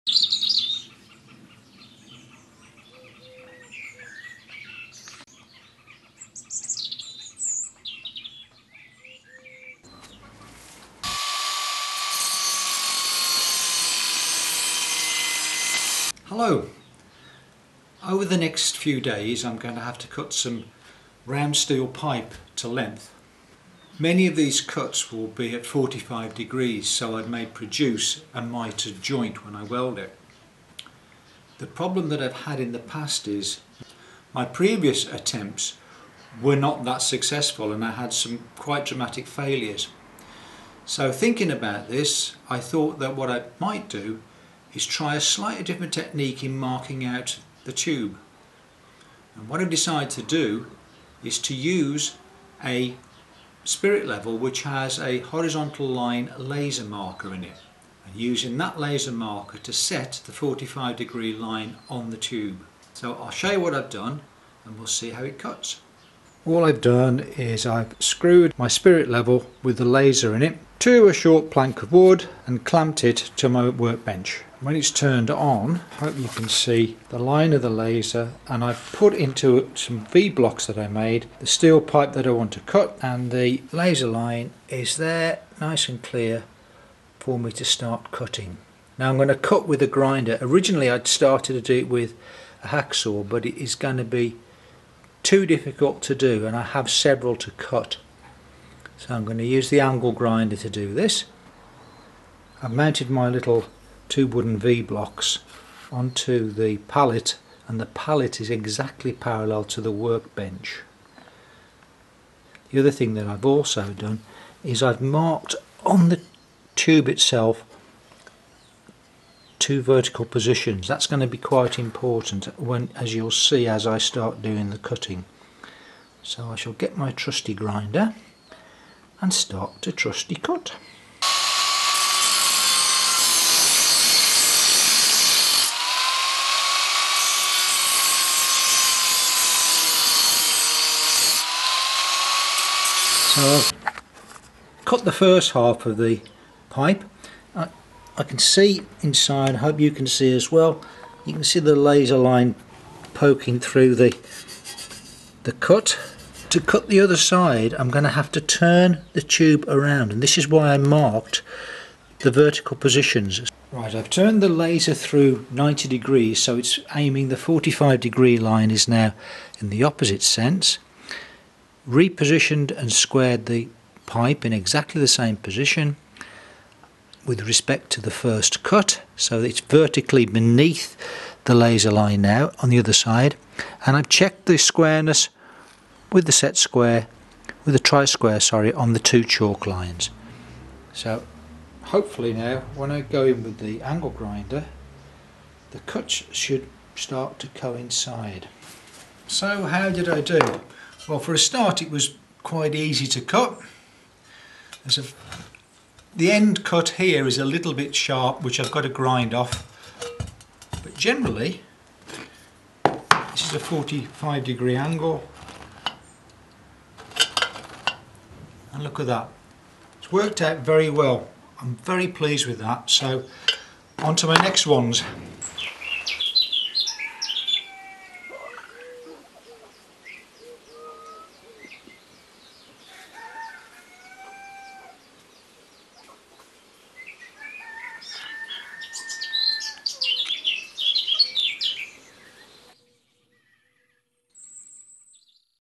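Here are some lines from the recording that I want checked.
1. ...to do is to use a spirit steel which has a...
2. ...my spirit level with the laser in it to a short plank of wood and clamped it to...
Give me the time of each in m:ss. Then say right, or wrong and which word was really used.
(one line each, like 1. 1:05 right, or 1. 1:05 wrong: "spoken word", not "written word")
1. 0:50 wrong: "level", not "steel"
2. 1:08 right.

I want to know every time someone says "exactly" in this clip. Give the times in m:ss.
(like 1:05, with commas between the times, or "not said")
1:48, 2:54.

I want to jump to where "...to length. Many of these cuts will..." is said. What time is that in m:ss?
0:22.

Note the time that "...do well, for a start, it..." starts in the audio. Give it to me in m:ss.
3:20.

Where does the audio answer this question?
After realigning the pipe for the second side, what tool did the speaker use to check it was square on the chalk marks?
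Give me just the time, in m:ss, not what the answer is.
3:07.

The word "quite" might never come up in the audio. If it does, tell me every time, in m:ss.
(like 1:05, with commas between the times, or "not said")
0:38, 2:01, 3:22.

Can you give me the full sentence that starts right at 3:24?
A, the end cut here is a little bit sharp, which I've got to grind off.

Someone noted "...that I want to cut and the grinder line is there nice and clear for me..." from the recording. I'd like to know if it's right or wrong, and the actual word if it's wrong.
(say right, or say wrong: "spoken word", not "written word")
wrong: "laser", not "grinder".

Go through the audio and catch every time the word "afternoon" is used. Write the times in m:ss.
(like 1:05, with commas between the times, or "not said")
not said.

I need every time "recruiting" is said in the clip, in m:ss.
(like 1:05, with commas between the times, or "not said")
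not said.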